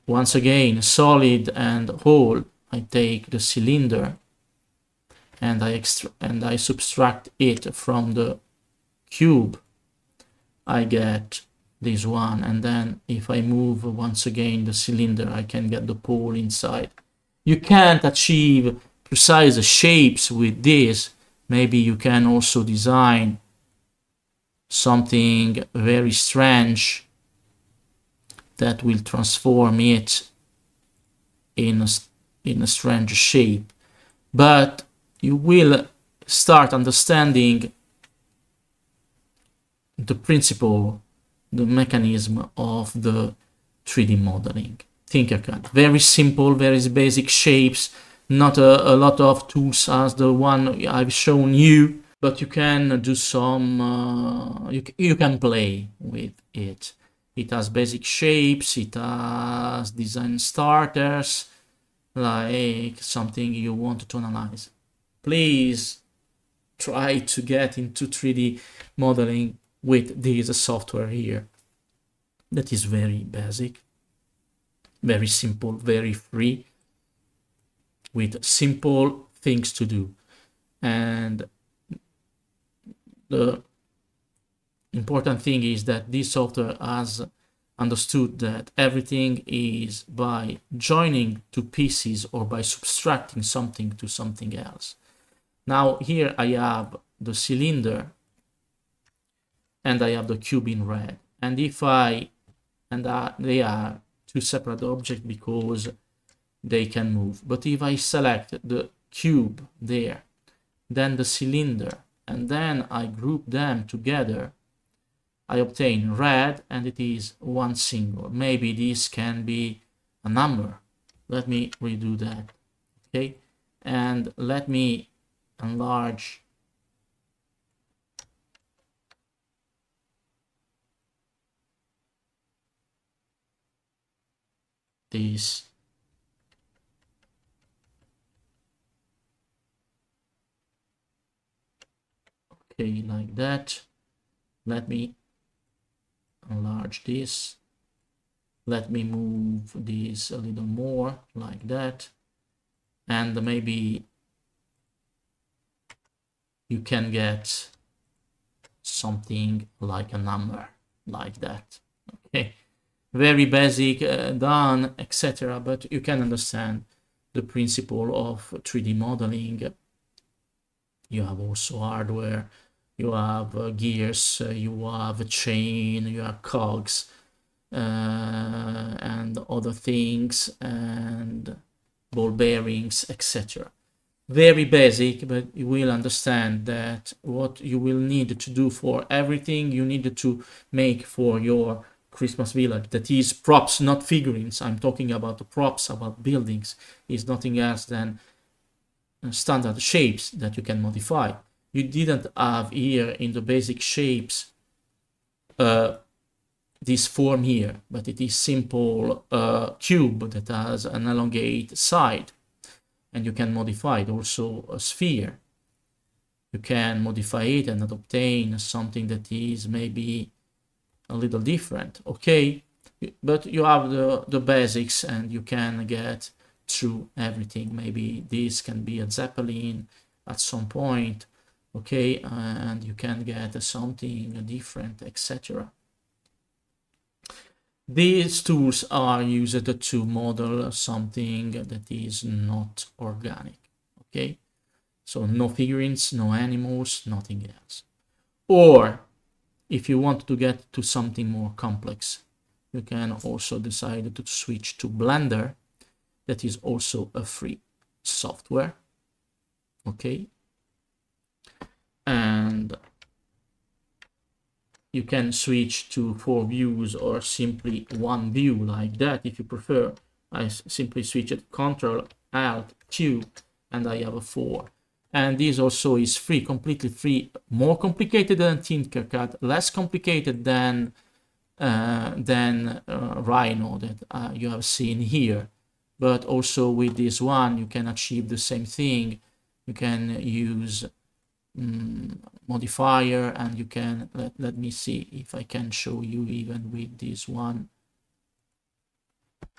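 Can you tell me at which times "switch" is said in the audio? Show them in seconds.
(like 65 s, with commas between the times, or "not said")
254 s, 265 s, 271 s.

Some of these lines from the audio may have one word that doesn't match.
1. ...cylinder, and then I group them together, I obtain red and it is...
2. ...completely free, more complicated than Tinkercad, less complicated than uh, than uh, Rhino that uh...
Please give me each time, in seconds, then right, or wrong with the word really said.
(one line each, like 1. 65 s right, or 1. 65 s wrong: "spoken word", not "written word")
1. 111 s right
2. 276 s right.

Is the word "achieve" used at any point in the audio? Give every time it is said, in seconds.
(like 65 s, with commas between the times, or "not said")
18 s, 287 s.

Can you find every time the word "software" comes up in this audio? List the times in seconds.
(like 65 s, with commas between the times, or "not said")
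70 s, 86 s, 258 s.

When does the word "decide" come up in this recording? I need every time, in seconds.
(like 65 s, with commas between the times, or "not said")
253 s.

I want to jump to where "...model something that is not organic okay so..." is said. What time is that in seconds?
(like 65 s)
240 s.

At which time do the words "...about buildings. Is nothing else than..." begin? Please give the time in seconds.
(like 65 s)
195 s.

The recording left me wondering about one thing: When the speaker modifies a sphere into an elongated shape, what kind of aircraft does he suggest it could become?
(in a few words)
Zeppelin.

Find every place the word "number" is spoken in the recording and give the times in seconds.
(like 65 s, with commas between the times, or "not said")
120 s, 160 s.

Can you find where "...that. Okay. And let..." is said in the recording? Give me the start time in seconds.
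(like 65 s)
122 s.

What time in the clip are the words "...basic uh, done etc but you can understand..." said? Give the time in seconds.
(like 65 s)
163 s.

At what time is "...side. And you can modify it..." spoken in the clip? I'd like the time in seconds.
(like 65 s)
211 s.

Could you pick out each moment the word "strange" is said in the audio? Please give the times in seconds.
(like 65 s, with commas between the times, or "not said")
26 s, 32 s.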